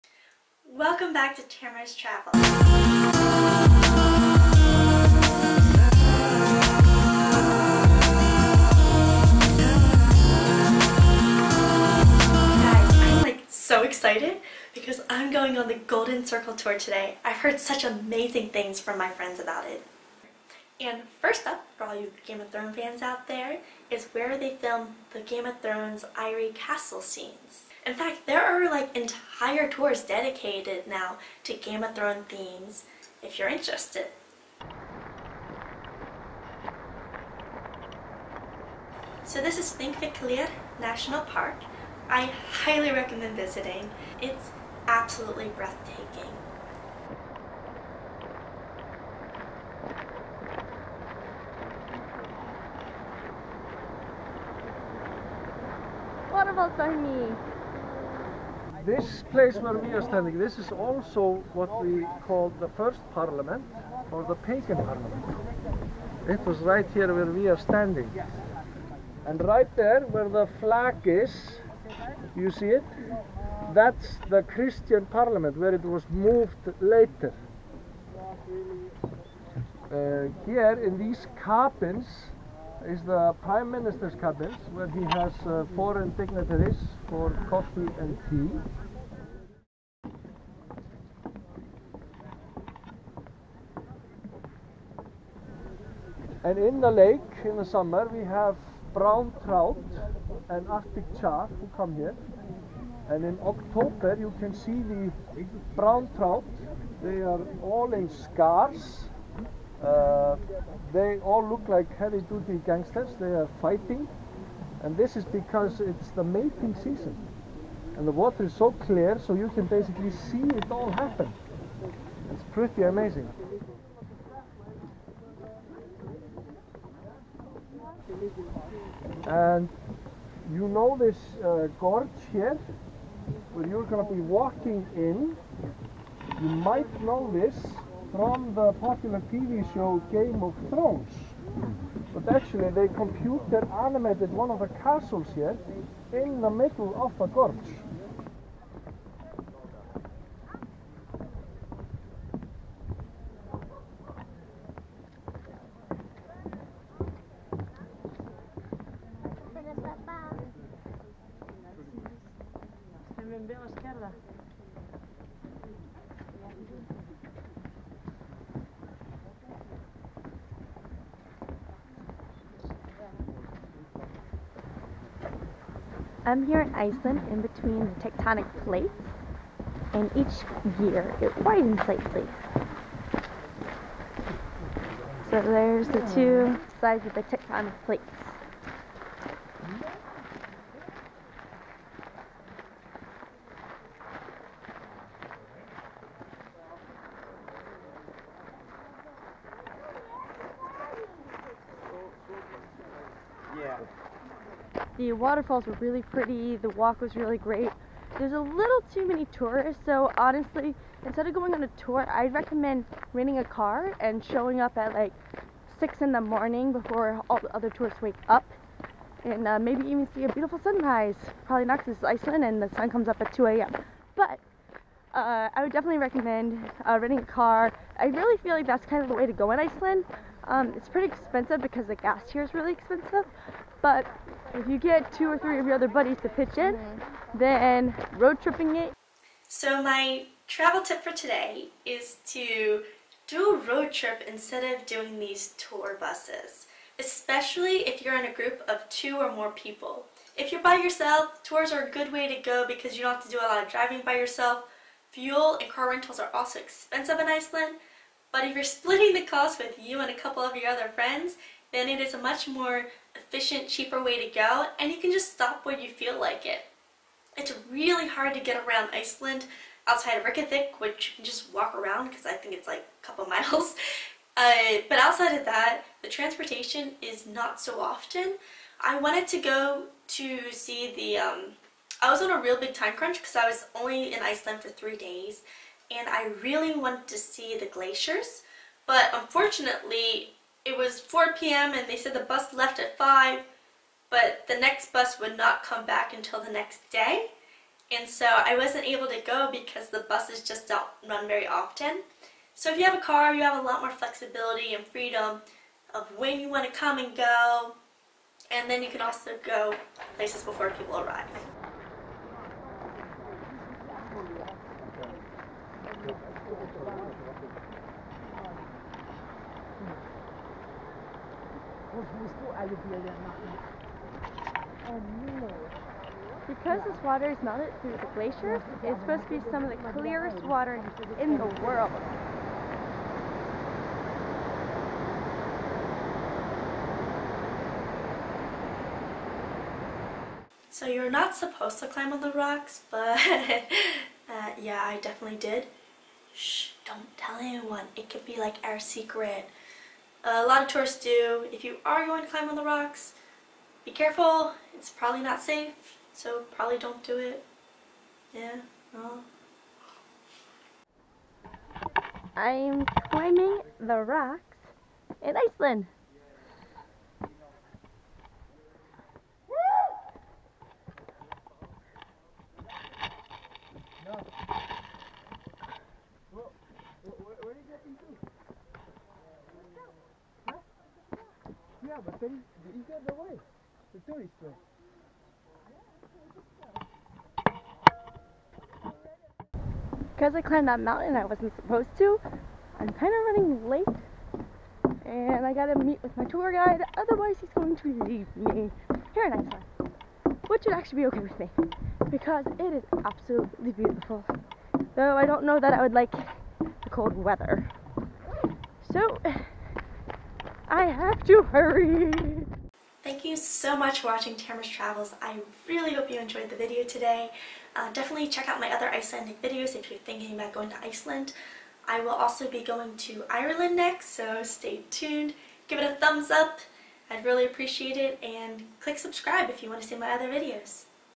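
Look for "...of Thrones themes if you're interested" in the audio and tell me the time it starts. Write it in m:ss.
0:31.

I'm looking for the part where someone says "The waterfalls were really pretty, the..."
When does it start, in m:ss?
3:25.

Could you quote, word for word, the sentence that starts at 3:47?
I really feel like that's kind of the way to go in Iceland.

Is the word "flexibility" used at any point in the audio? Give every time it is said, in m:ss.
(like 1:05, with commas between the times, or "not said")
5:03.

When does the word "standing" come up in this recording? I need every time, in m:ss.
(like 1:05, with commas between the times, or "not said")
1:00, 1:07.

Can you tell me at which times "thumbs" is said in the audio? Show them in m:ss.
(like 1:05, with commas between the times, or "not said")
7:05.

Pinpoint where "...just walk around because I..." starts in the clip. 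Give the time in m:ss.
4:31.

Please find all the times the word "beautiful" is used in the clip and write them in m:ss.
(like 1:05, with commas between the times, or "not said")
3:40, 6:43.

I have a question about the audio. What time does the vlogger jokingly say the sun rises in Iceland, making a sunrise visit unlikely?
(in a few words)
2 a.m.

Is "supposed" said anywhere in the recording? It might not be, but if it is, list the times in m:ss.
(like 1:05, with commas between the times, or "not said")
5:29, 5:41, 6:31.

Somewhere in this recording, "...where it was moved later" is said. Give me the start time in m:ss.
1:15.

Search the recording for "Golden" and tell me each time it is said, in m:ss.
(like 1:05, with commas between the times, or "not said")
0:15.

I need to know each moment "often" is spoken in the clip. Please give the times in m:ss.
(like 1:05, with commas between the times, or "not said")
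4:37, 5:01.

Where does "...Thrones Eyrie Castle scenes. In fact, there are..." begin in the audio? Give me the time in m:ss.
0:25.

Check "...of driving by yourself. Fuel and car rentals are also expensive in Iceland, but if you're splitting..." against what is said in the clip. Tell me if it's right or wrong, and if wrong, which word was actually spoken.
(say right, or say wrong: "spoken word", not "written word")
right.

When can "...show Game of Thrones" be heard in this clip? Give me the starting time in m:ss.
2:19.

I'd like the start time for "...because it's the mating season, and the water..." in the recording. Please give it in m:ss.
1:55.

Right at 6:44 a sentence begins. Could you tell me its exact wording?
Though I don't know that I would like the cold weather.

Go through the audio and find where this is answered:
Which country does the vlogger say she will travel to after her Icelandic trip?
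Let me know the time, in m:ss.
7:03.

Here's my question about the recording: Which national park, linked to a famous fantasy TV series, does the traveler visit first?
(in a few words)
Thingvellir National Park.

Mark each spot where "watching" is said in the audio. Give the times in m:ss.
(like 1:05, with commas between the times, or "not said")
6:54.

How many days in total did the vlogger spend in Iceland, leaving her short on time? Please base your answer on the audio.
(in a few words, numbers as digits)
3.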